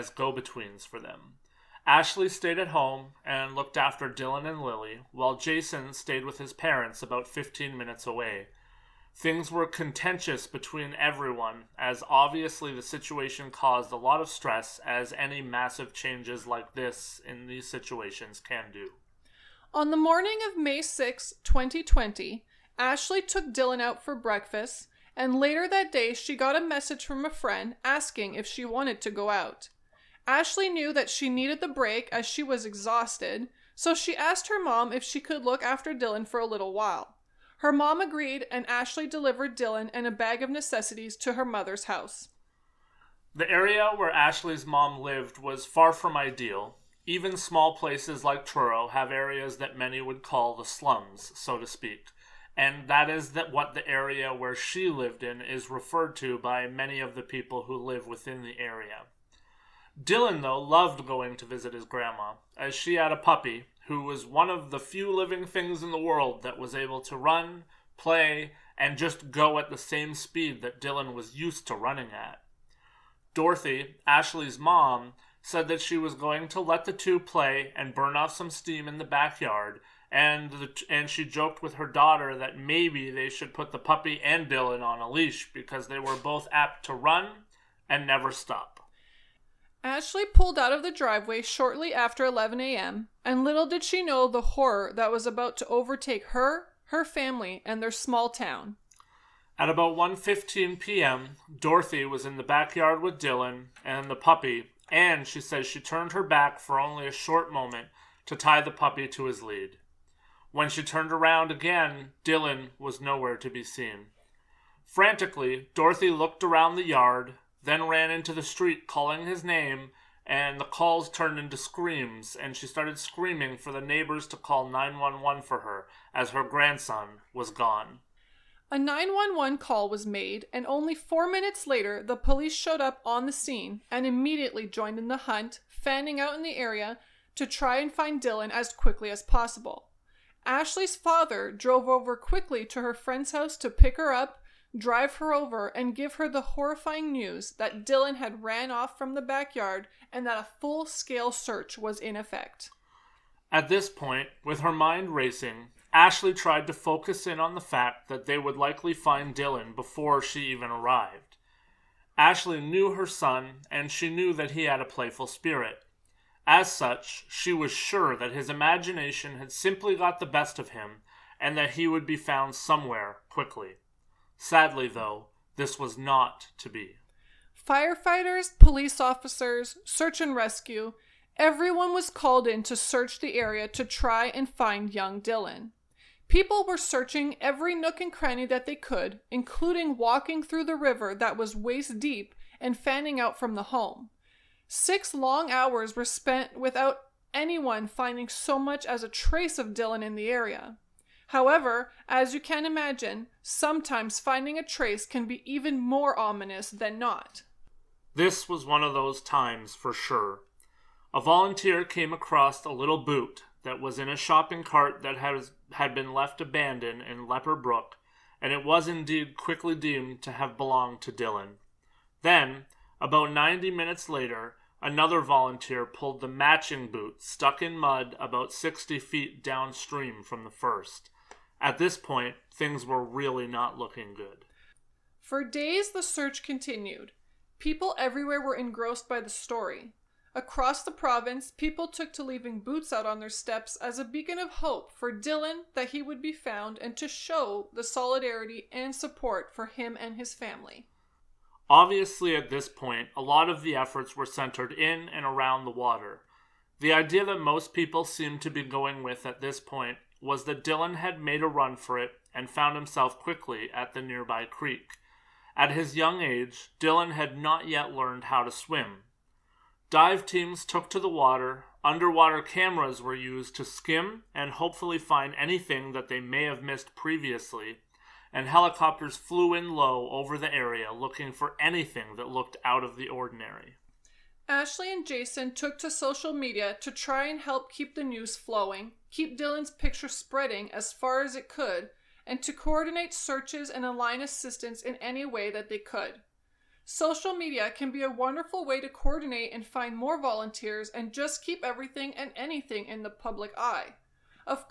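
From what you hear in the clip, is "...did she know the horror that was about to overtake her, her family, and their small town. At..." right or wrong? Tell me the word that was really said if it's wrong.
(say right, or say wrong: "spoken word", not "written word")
right.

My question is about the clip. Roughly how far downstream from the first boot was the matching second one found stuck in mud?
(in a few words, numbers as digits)
60 feet.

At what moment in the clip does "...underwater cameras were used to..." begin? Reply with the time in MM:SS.
04:31.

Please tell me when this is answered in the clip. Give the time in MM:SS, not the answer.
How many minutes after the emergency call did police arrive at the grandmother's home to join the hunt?
02:10.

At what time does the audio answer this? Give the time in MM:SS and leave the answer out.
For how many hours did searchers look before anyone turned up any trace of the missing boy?
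03:14.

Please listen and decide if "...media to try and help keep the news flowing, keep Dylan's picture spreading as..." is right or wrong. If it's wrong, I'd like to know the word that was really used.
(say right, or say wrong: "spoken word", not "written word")
right.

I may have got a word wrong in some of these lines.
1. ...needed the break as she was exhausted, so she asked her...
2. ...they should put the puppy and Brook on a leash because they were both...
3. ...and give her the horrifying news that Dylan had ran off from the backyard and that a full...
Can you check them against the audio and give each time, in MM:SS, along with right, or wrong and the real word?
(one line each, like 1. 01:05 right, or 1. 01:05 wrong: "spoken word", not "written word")
1. 00:31 right
2. 01:23 wrong: "Dylan", not "Brook"
3. 02:25 right.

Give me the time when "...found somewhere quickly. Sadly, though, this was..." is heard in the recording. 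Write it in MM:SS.
02:52.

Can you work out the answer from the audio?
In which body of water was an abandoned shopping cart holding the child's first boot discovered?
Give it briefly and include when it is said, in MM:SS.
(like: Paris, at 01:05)
Lepper Brook, at 03:37.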